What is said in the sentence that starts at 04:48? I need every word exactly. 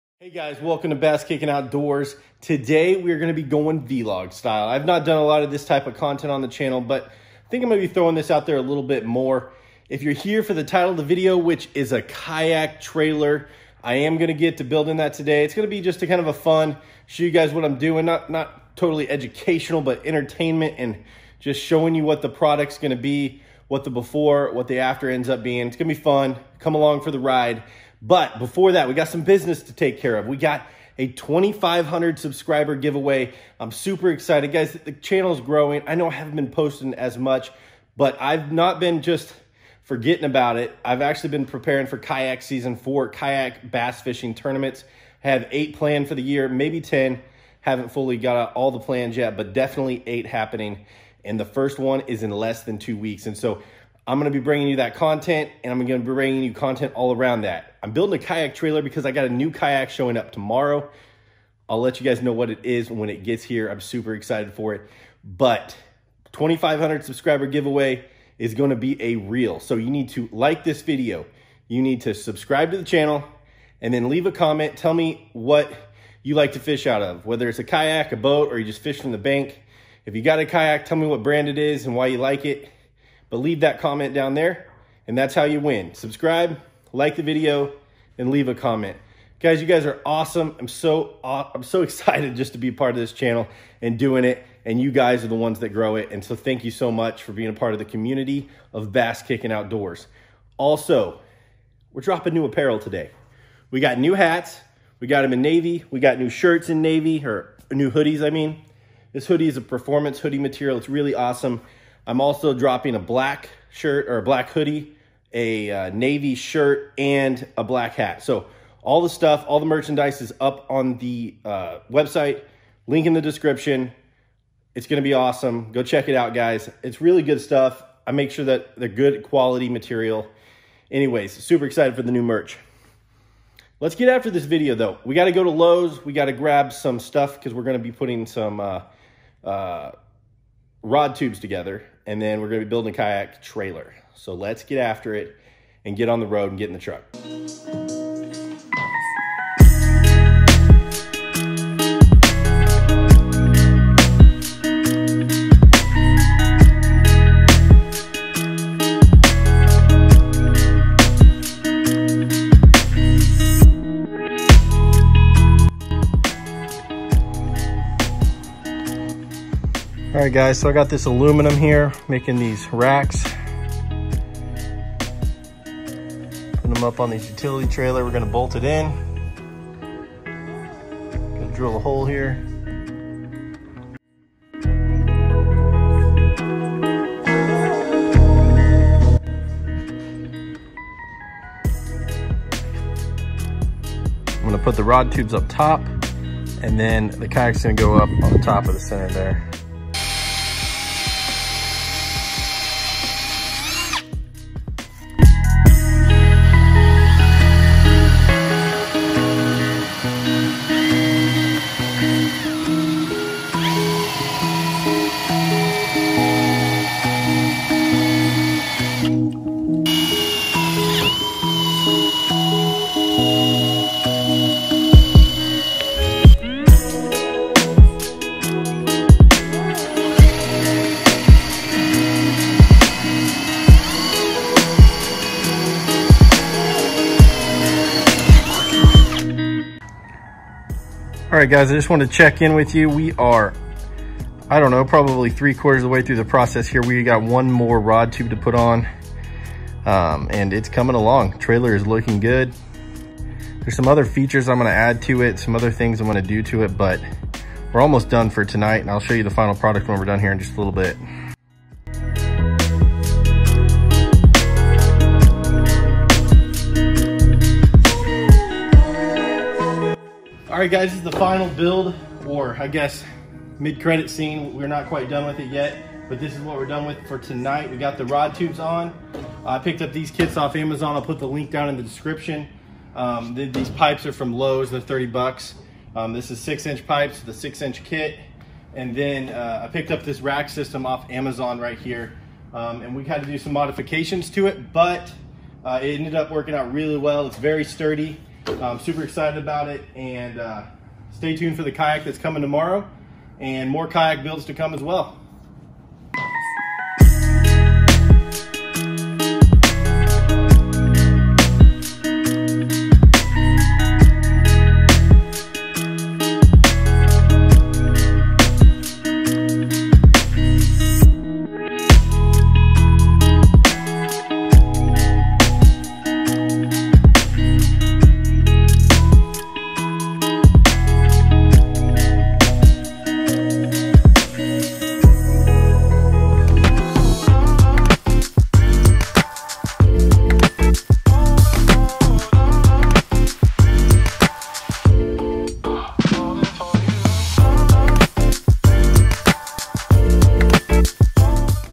And then uh, I picked up this rack system off Amazon right here.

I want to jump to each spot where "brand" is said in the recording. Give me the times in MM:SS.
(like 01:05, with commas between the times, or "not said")
01:21.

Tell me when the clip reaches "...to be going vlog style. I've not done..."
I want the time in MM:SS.
00:03.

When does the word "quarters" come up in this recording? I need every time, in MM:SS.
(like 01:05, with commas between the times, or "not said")
04:05.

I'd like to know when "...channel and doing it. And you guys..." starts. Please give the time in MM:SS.
01:33.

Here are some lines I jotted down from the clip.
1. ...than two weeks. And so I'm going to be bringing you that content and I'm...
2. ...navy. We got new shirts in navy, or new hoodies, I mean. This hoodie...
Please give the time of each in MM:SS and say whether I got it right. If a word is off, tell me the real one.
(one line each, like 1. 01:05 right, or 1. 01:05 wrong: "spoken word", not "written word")
1. 00:52 right
2. 01:45 right.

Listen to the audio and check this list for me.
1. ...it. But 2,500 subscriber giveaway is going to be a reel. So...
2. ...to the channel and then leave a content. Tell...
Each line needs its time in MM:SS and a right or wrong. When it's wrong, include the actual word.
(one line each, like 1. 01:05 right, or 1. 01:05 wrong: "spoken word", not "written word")
1. 01:04 right
2. 01:12 wrong: "comment", not "content".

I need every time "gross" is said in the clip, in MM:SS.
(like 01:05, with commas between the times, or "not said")
not said.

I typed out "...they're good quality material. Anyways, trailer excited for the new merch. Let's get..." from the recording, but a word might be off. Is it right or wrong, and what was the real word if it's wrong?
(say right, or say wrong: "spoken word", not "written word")
wrong: "super", not "trailer".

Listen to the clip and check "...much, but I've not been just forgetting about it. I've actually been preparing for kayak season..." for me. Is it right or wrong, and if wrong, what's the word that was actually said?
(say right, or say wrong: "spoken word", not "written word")
right.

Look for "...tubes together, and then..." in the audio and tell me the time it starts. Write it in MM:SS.
02:21.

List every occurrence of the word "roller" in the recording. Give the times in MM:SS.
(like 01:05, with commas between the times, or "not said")
not said.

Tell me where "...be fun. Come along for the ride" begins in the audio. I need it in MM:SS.
00:25.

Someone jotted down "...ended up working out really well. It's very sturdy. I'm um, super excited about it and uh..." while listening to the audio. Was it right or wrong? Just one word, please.
right.